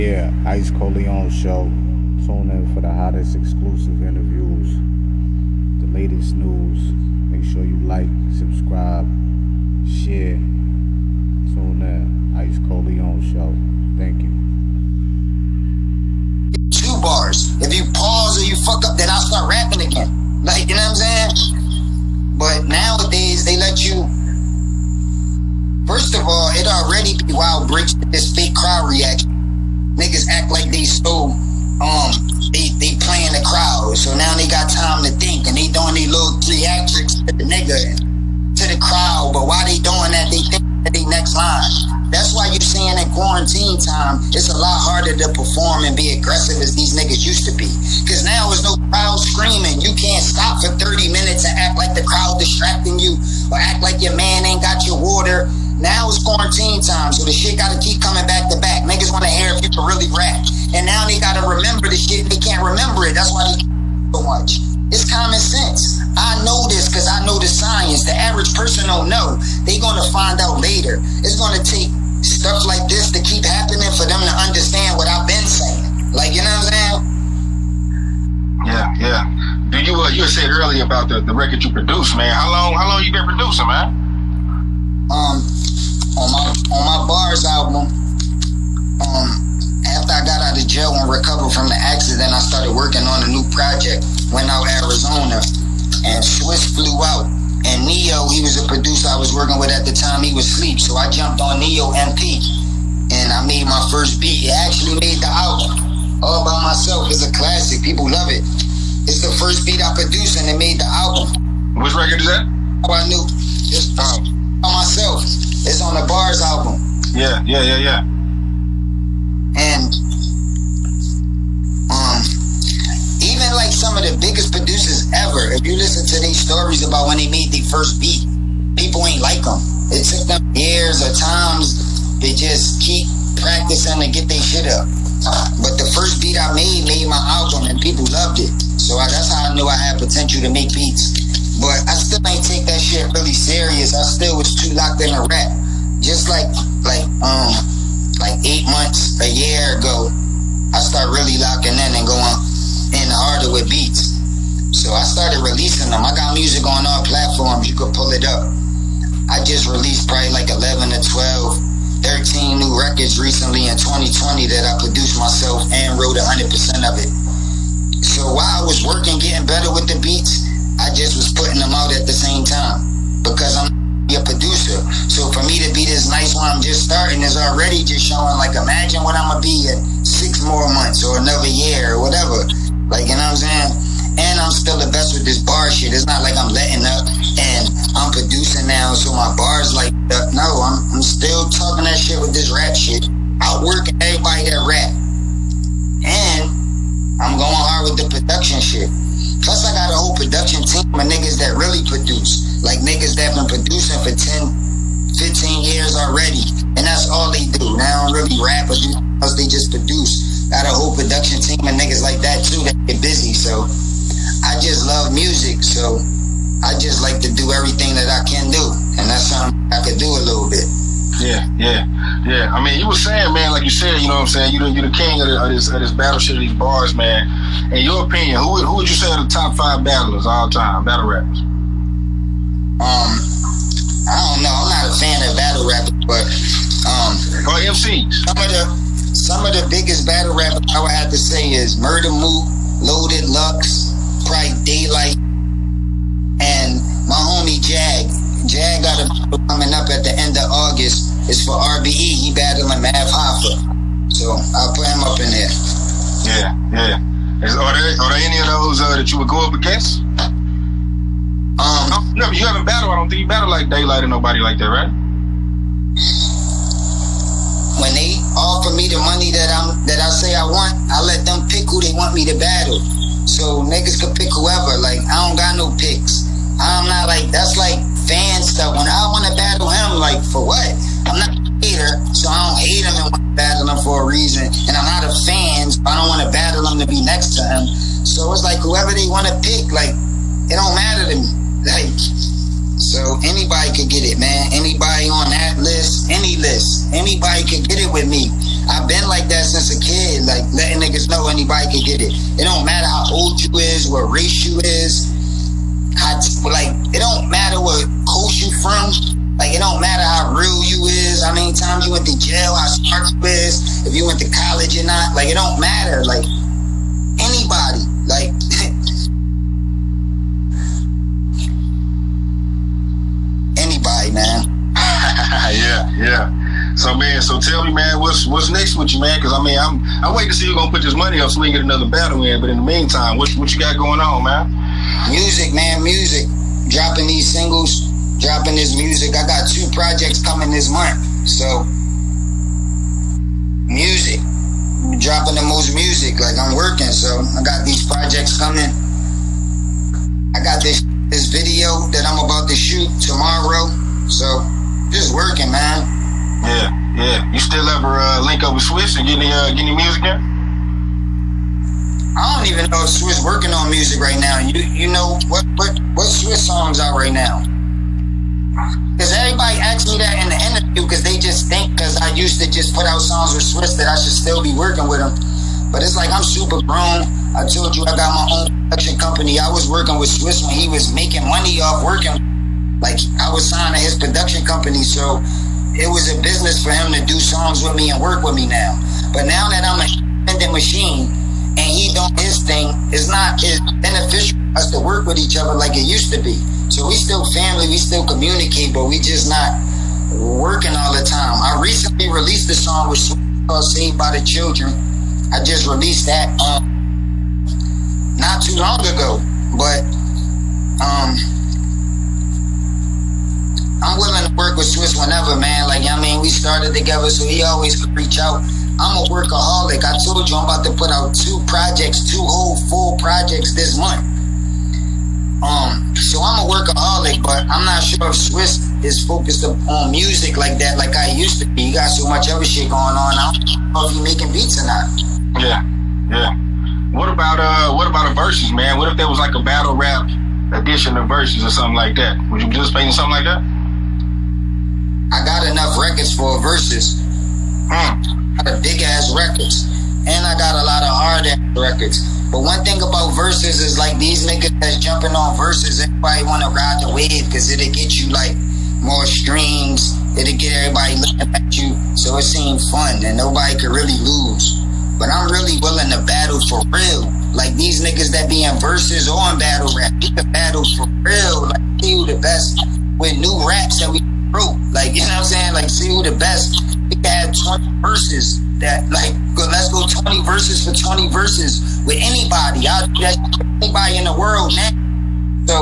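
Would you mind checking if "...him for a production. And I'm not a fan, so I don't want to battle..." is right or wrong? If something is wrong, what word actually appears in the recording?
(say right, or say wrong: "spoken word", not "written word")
wrong: "reason", not "production".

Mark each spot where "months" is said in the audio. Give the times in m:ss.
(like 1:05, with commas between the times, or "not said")
2:28, 3:00, 5:40, 7:03.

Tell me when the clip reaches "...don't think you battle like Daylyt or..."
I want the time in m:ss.
4:22.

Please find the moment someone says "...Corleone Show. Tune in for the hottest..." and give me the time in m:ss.
0:00.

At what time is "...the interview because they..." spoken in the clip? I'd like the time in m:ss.
6:10.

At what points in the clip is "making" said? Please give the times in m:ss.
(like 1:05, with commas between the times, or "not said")
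6:20, 7:14.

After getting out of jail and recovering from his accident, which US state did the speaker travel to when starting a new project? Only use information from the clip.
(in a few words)
Arizona.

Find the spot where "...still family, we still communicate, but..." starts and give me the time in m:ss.
6:36.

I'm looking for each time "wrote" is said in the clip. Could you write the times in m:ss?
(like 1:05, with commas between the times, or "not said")
2:45, 7:54.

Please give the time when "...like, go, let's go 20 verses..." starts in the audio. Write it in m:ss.
7:58.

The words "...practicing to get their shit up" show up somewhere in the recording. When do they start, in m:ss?
2:13.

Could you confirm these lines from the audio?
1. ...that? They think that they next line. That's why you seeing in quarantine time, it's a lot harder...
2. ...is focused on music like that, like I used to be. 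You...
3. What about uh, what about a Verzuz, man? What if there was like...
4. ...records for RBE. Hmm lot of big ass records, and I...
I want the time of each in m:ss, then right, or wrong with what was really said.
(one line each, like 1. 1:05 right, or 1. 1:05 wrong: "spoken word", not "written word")
1. 0:40 right
2. 7:08 right
3. 7:16 right
4. 7:25 wrong: "Verzuz", not "RBE".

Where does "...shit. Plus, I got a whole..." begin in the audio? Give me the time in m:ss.
3:18.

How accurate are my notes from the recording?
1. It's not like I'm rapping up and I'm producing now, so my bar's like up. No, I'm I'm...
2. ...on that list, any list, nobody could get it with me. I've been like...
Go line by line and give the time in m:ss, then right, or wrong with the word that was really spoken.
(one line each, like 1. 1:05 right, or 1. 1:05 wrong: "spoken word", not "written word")
1. 3:05 wrong: "letting", not "rapping"
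2. 4:55 wrong: "anybody", not "nobody".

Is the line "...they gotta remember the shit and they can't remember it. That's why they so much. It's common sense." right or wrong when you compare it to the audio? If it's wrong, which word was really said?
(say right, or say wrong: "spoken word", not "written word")
right.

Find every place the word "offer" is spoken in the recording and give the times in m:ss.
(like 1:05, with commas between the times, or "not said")
4:28.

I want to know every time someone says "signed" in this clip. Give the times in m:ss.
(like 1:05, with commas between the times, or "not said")
6:23.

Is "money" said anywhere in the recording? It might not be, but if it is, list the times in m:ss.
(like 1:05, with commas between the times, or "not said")
4:29, 5:30, 6:21.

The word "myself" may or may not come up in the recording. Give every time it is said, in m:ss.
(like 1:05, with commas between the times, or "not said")
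1:46, 1:54, 2:45.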